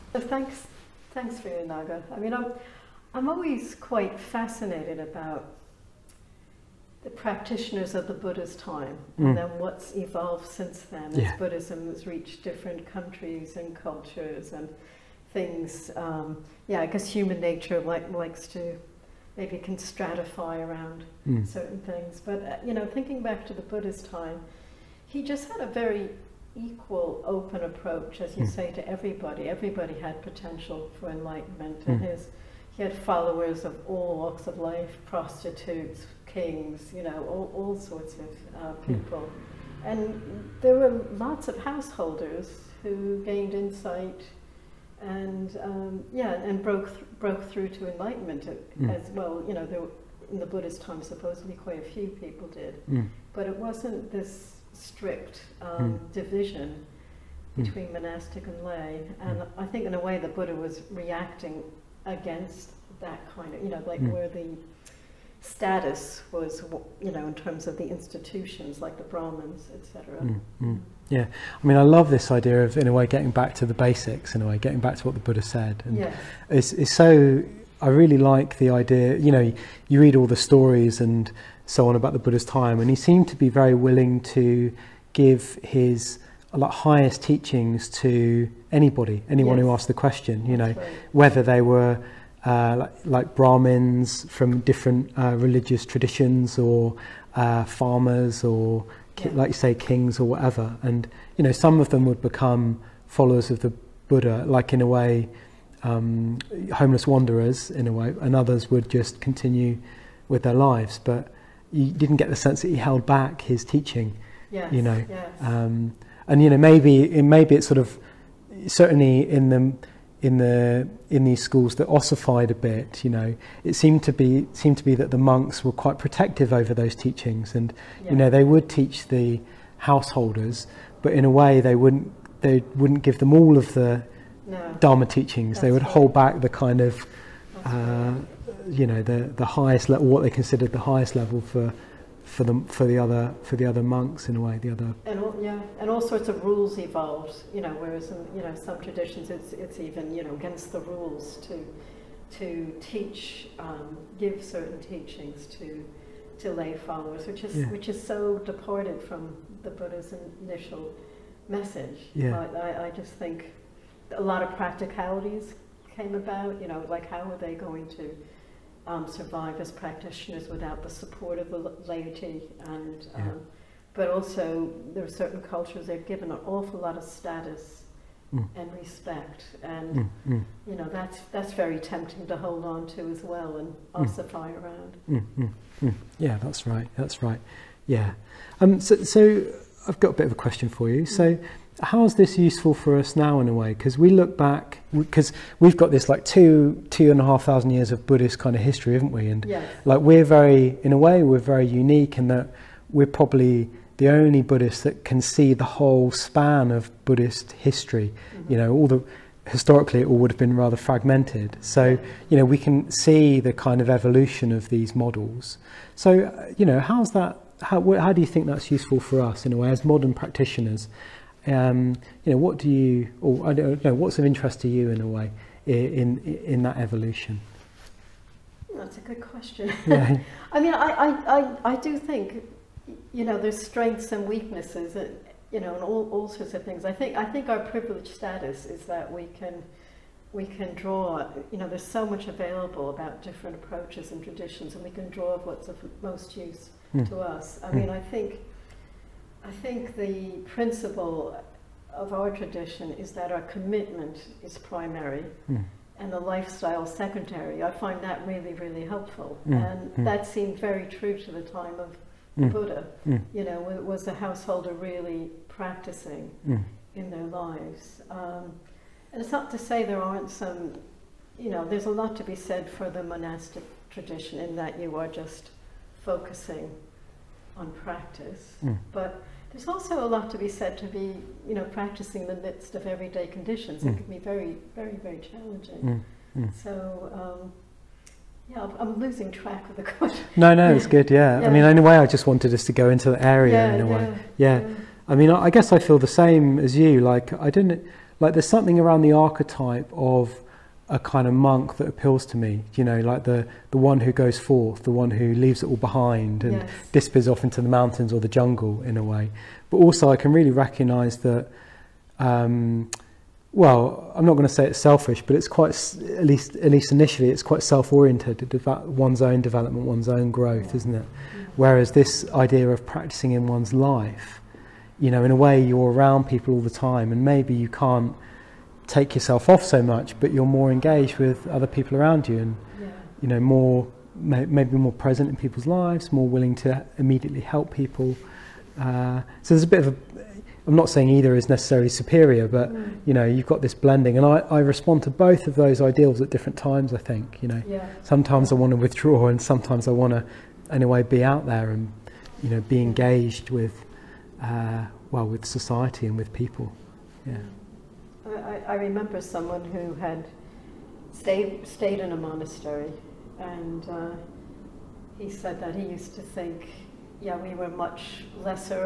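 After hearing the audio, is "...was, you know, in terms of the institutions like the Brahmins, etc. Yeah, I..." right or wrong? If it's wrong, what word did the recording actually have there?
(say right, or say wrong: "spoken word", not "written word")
right.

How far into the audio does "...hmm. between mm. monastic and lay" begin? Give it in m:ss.
0:57.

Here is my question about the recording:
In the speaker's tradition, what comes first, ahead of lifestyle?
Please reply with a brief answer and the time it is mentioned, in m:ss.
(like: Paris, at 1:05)
commitment, at 4:13.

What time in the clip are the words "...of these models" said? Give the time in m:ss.
3:34.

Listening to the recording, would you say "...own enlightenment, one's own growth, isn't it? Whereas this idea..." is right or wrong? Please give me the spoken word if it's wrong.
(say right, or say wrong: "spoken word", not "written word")
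wrong: "development", not "enlightenment".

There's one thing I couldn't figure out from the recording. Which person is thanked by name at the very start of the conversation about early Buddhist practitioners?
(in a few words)
Viryanaga.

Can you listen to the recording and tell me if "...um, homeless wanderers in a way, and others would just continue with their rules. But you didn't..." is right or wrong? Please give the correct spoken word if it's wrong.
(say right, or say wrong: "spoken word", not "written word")
wrong: "lives", not "rules".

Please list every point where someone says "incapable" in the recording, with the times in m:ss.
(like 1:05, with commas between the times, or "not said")
not said.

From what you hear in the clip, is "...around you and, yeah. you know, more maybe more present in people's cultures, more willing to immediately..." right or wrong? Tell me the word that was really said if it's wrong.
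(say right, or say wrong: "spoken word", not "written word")
wrong: "lives", not "cultures".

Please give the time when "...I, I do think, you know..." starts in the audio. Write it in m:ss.
3:51.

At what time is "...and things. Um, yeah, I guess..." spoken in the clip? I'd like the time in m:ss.
0:14.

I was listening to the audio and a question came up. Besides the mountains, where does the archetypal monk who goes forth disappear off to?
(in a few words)
the jungle.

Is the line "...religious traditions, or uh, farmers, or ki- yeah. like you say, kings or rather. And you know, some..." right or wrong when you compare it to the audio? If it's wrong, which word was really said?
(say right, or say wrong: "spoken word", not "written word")
wrong: "whatever", not "rather".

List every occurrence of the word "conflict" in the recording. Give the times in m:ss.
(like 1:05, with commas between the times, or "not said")
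not said.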